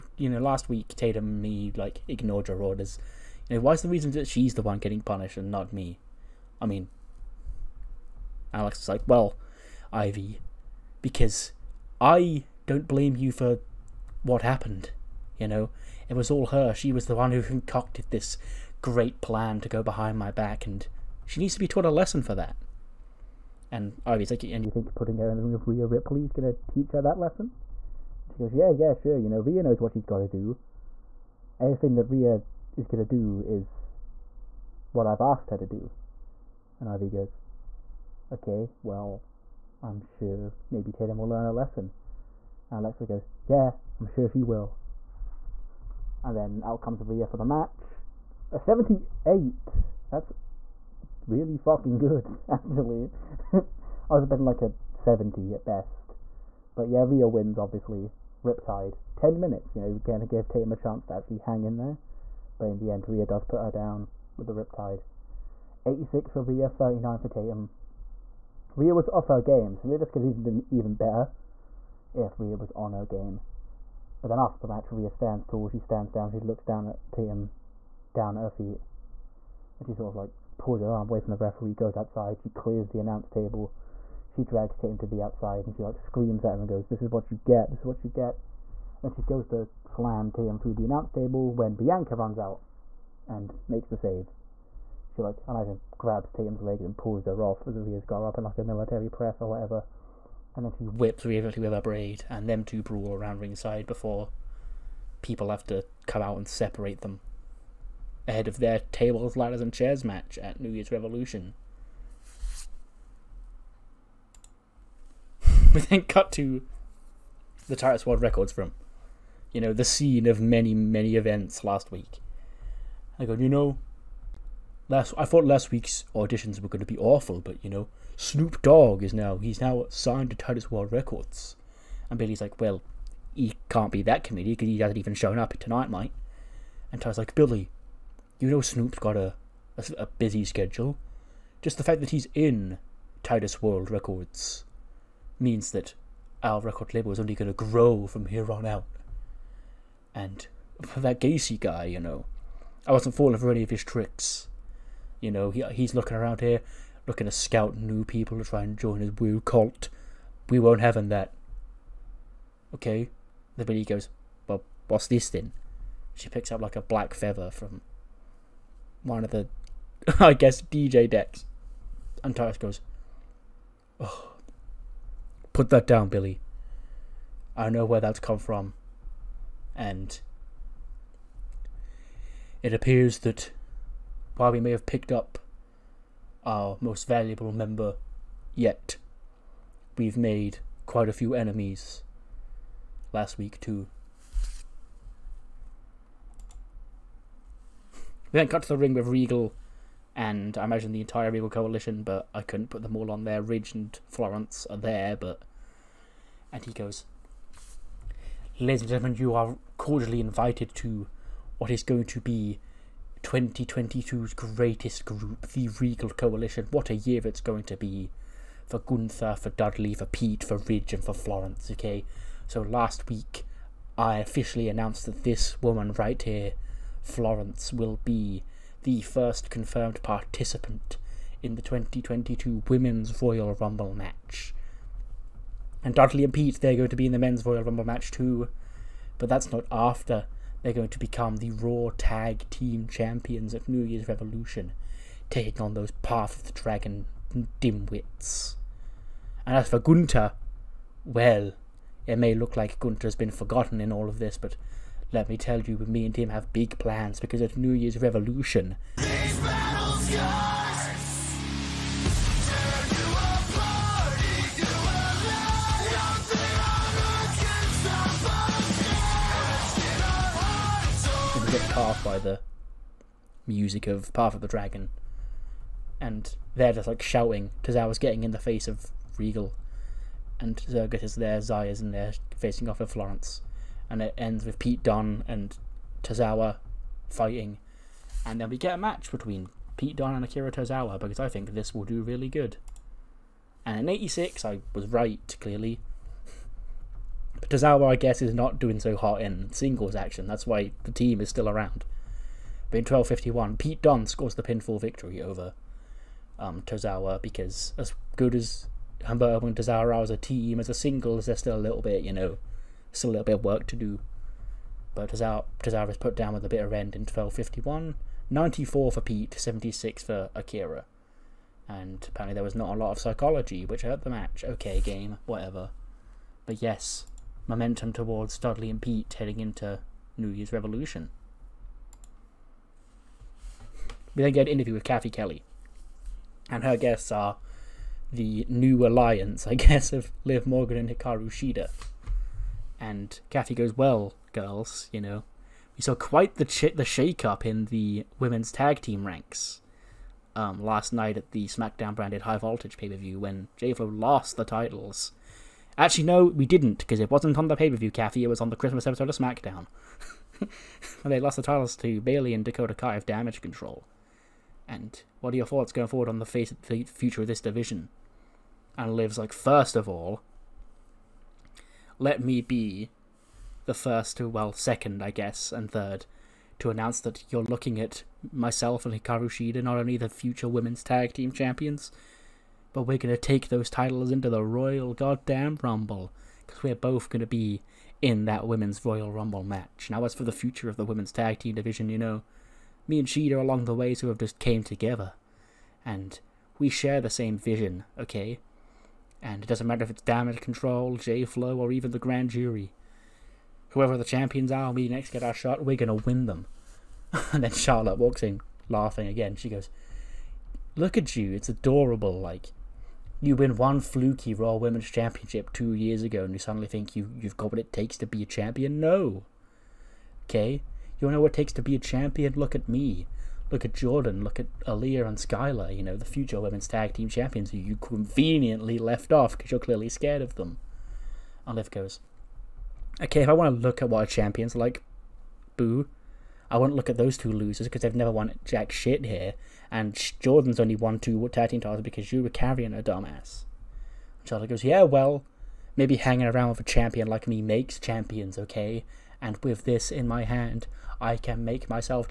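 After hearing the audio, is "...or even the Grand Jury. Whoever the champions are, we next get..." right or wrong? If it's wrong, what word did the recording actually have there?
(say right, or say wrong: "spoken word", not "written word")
right.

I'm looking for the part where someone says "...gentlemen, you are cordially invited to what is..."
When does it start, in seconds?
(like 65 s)
208 s.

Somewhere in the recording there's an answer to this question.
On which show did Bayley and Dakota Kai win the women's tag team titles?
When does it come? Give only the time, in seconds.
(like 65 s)
358 s.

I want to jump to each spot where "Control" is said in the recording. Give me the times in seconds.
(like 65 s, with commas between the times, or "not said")
363 s, 400 s.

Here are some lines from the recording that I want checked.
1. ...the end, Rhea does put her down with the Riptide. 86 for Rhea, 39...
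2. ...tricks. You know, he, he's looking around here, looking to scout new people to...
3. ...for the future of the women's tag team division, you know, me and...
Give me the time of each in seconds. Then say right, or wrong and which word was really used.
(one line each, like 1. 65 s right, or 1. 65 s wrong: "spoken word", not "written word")
1. 62 s right
2. 153 s right
3. 390 s right.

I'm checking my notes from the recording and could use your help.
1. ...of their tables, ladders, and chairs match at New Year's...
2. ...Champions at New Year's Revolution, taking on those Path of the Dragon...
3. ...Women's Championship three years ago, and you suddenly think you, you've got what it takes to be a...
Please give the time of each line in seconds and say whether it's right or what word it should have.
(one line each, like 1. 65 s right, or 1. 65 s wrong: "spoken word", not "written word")
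1. 108 s right
2. 242 s right
3. 414 s wrong: "two", not "three".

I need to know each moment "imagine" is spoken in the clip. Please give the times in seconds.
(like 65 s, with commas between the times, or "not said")
95 s, 200 s.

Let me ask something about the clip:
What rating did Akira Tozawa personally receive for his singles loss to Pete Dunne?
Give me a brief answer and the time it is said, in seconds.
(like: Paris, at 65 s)
76, at 319 s.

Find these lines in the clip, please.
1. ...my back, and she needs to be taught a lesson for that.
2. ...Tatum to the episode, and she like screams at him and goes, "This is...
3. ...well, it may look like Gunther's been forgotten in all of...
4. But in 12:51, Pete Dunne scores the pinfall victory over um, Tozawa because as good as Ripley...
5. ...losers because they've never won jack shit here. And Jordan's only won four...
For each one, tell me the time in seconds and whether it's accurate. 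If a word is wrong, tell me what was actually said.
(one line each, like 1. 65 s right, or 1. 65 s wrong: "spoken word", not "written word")
1. 20 s right
2. 84 s wrong: "outside", not "episode"
3. 251 s right
4. 302 s wrong: "Humberto", not "Ripley"
5. 437 s wrong: "two", not "four".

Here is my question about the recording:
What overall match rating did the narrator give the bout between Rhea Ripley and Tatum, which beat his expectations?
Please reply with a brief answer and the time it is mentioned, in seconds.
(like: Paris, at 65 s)
78, at 48 s.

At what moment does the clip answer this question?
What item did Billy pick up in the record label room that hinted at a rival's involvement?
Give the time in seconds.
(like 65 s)
166 s.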